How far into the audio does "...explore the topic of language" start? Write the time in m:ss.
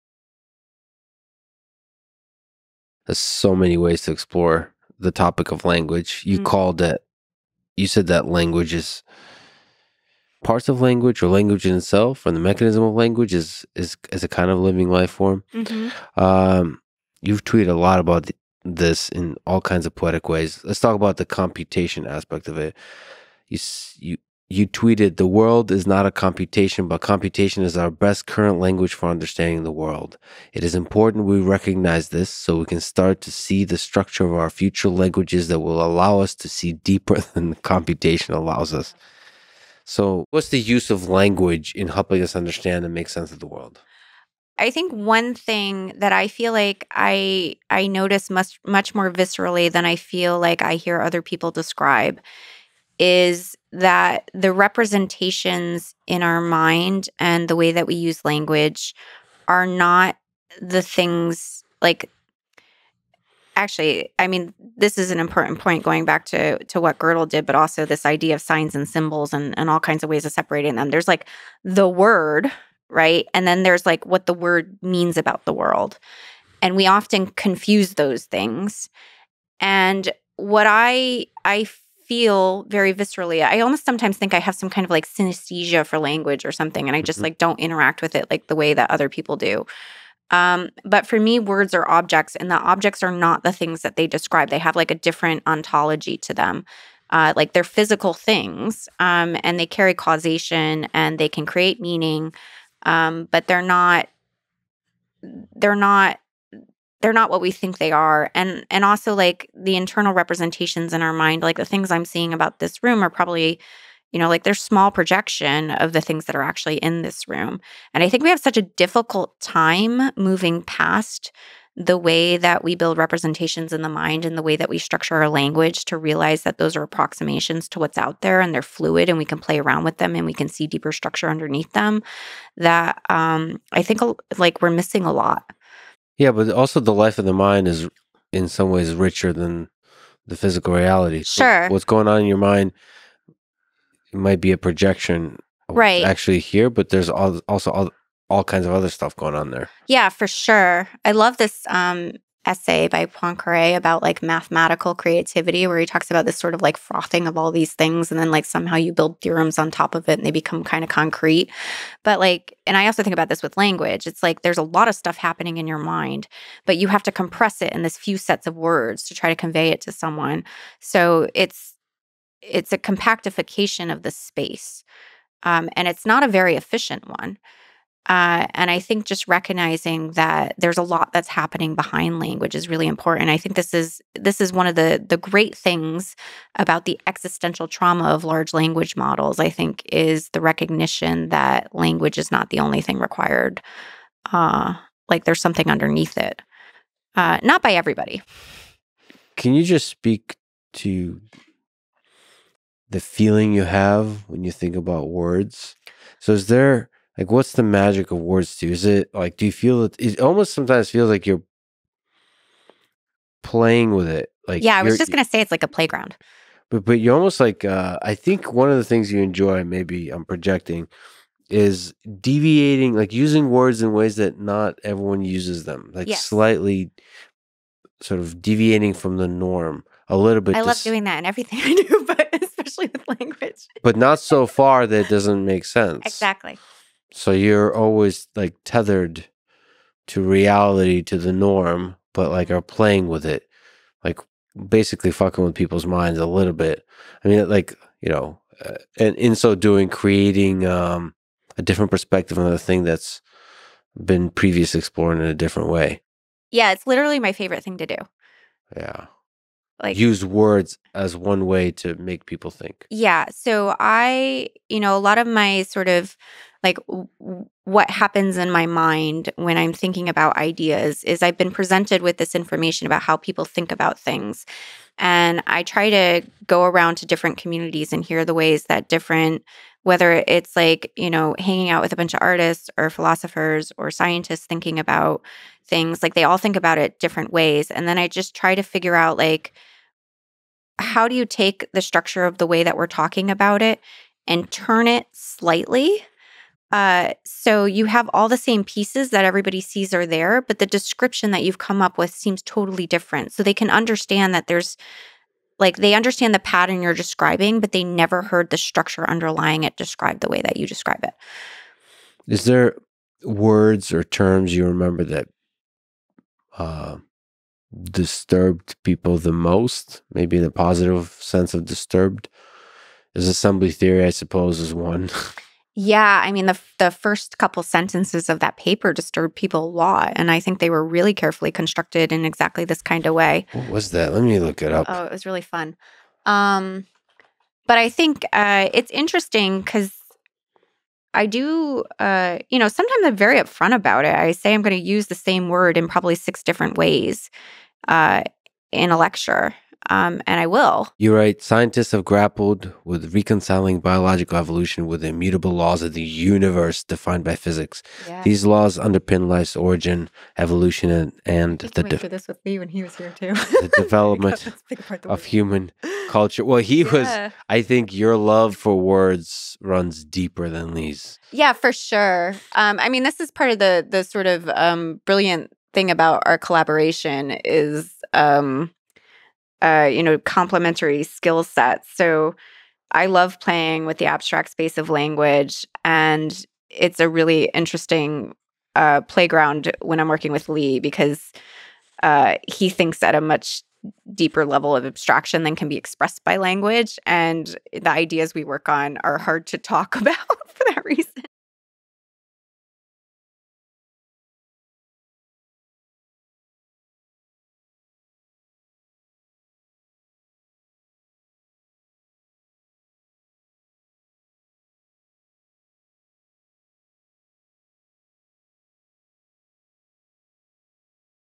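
0:04.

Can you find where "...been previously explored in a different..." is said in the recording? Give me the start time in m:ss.
4:14.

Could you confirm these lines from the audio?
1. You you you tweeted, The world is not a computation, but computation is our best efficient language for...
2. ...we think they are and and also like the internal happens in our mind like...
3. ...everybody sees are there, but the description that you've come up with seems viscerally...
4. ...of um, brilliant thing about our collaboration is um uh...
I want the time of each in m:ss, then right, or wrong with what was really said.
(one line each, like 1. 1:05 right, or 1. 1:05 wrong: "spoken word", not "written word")
1. 0:23 wrong: "current", not "efficient"
2. 1:47 wrong: "representations", not "happens"
3. 4:59 wrong: "totally", not "viscerally"
4. 6:14 right.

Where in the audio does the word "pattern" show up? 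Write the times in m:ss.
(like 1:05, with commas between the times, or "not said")
5:06.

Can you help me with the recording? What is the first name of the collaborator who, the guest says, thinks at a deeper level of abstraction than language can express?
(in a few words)
Lee.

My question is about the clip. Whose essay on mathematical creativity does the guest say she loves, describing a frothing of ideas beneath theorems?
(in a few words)
Poincare.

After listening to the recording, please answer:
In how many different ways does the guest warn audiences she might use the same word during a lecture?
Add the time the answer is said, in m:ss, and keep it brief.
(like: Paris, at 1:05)
6, at 5:46.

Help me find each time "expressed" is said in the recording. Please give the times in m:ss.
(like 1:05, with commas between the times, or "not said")
6:35.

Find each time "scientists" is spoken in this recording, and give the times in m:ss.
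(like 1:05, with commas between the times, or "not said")
4:43, 5:51.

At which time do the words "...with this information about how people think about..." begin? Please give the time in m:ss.
4:32.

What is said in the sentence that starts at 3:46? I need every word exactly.
slightly sort of deviating from the norm a little bit.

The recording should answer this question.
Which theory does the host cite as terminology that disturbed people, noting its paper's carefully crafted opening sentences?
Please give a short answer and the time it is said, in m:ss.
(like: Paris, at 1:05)
Assembly theory, at 5:23.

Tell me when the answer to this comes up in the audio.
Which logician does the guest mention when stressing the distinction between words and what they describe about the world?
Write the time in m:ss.
1:06.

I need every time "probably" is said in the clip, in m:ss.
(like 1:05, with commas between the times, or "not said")
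1:53, 5:45.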